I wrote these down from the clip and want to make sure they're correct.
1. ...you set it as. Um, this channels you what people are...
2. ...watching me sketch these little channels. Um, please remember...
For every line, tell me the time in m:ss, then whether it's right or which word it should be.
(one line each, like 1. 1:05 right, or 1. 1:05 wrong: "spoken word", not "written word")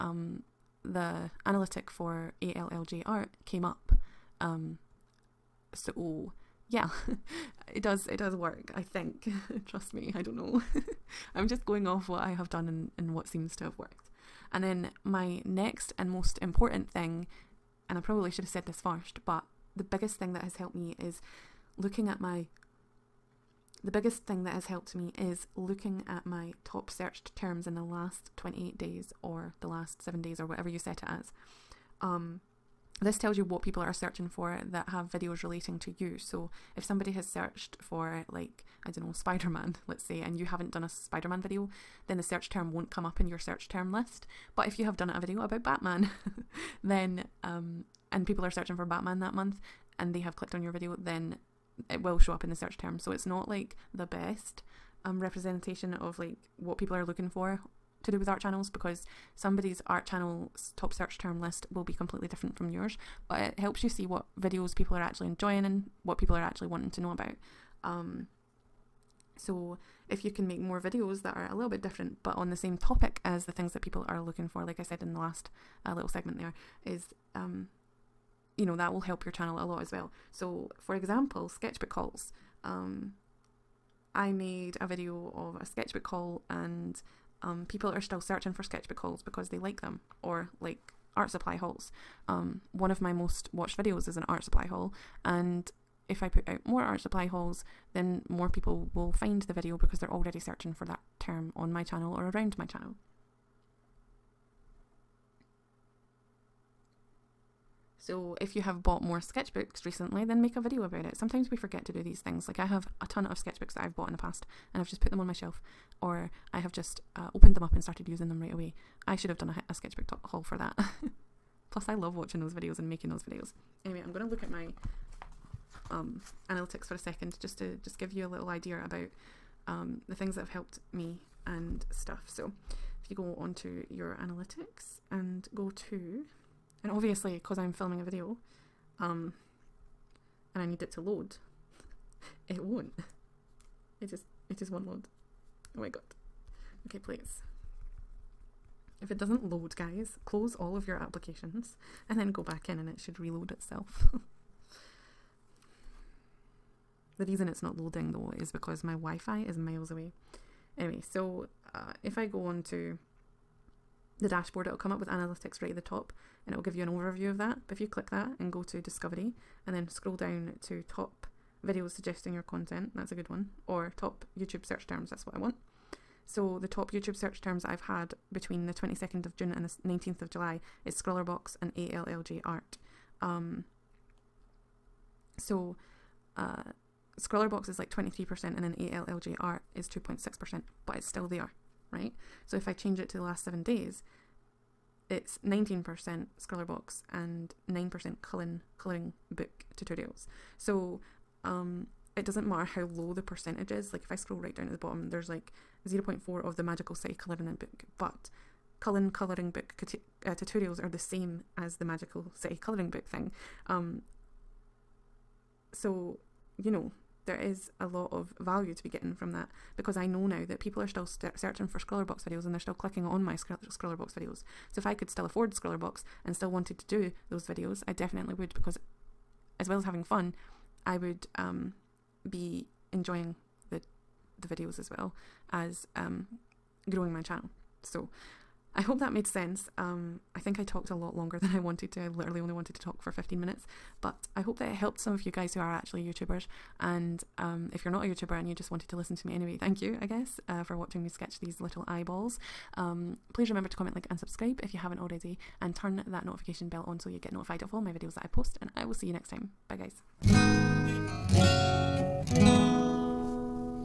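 1. 0:30 wrong: "tells", not "channels"
2. 4:10 wrong: "eyeballs", not "channels".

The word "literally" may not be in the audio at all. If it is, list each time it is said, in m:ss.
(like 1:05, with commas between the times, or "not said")
4:02.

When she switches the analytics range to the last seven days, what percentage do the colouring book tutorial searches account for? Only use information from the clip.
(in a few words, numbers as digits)
9%.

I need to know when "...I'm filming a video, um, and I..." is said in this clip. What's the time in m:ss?
2:17.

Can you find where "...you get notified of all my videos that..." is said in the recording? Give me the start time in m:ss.
4:17.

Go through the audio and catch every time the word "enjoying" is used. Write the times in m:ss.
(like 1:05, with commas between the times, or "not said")
1:05, 3:52.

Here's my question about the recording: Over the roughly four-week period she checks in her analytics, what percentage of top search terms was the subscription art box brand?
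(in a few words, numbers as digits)
23%.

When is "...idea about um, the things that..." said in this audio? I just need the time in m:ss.
2:08.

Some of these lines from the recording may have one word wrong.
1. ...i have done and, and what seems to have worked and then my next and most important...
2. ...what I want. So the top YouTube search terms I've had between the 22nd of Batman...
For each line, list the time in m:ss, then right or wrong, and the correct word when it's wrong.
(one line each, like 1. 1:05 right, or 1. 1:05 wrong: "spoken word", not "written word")
1. 0:12 right
2. 2:55 wrong: "June", not "Batman".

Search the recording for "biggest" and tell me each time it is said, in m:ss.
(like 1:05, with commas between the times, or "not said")
0:19, 0:23.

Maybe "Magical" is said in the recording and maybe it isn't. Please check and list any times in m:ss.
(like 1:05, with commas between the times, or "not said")
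3:26, 3:31.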